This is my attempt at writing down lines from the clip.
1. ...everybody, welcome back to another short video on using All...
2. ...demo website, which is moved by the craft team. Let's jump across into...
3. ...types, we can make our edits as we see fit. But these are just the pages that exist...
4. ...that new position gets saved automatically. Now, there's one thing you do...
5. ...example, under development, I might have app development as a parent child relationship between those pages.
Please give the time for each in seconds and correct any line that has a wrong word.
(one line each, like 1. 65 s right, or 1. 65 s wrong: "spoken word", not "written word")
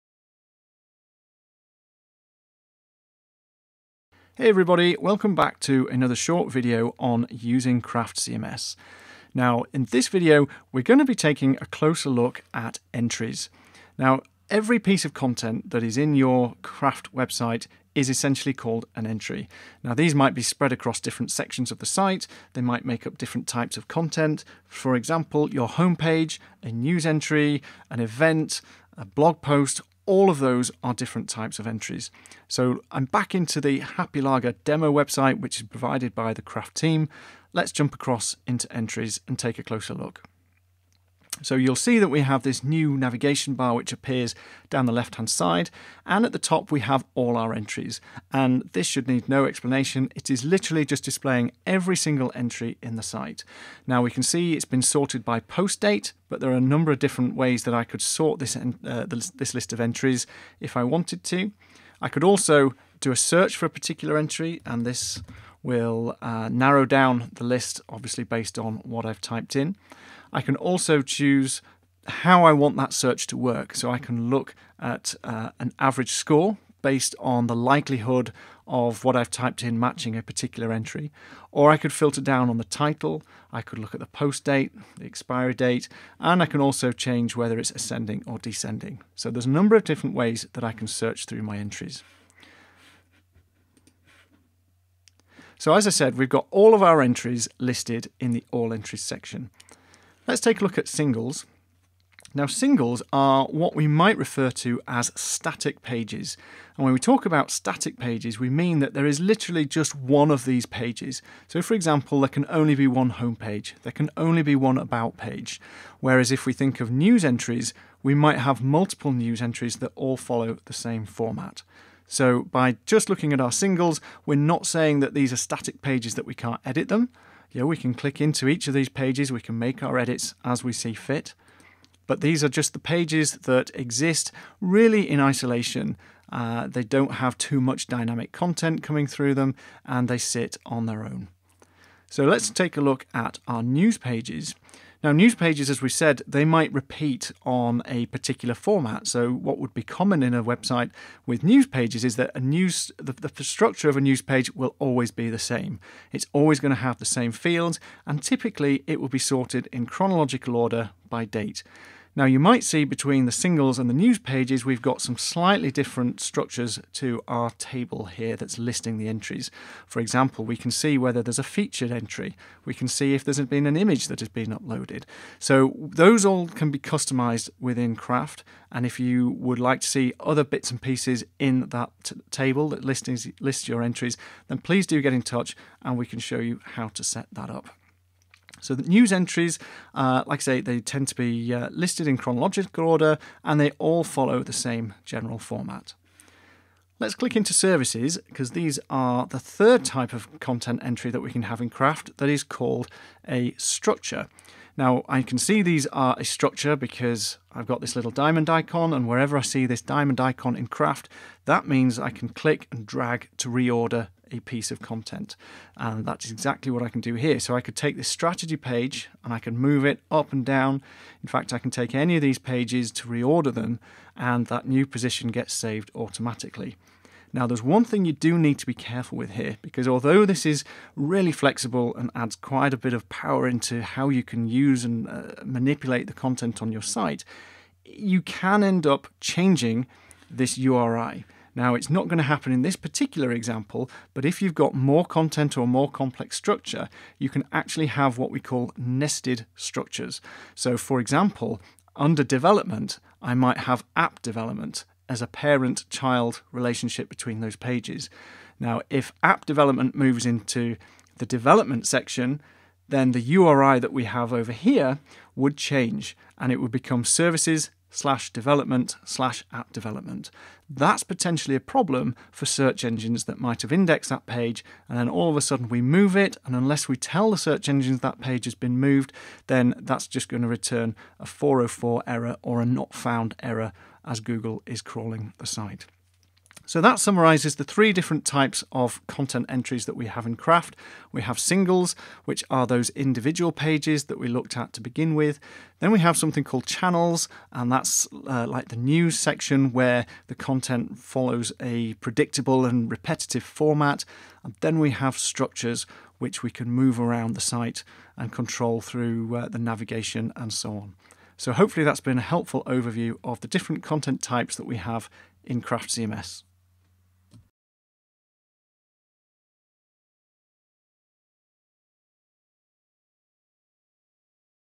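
1. 4 s wrong: "Craft", not "All"
2. 34 s wrong: "provided", not "moved"
3. 128 s wrong: "pages", not "types"
4. 224 s right
5. 251 s right.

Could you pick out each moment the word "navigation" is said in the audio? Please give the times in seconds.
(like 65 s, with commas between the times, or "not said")
42 s, 309 s.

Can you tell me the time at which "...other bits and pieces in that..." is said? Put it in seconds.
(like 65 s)
180 s.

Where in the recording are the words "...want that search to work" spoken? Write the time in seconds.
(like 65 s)
72 s.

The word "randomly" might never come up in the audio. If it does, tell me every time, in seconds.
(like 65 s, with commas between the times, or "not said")
not said.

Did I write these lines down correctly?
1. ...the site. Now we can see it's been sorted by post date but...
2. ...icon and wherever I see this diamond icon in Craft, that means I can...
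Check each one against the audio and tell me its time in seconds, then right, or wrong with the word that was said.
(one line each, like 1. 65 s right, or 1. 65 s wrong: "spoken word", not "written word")
1. 52 s right
2. 208 s right.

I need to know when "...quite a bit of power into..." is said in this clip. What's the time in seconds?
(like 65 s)
232 s.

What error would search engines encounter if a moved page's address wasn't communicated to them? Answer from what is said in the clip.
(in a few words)
404 error.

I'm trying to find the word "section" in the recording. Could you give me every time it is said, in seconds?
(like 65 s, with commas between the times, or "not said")
21 s, 99 s, 261 s, 299 s.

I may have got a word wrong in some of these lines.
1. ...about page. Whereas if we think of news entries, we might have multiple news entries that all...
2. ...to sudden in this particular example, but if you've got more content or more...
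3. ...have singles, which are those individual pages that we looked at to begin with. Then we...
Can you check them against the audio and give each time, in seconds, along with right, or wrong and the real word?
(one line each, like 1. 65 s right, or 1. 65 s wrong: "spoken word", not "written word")
1. 114 s right
2. 242 s wrong: "happen", not "sudden"
3. 291 s right.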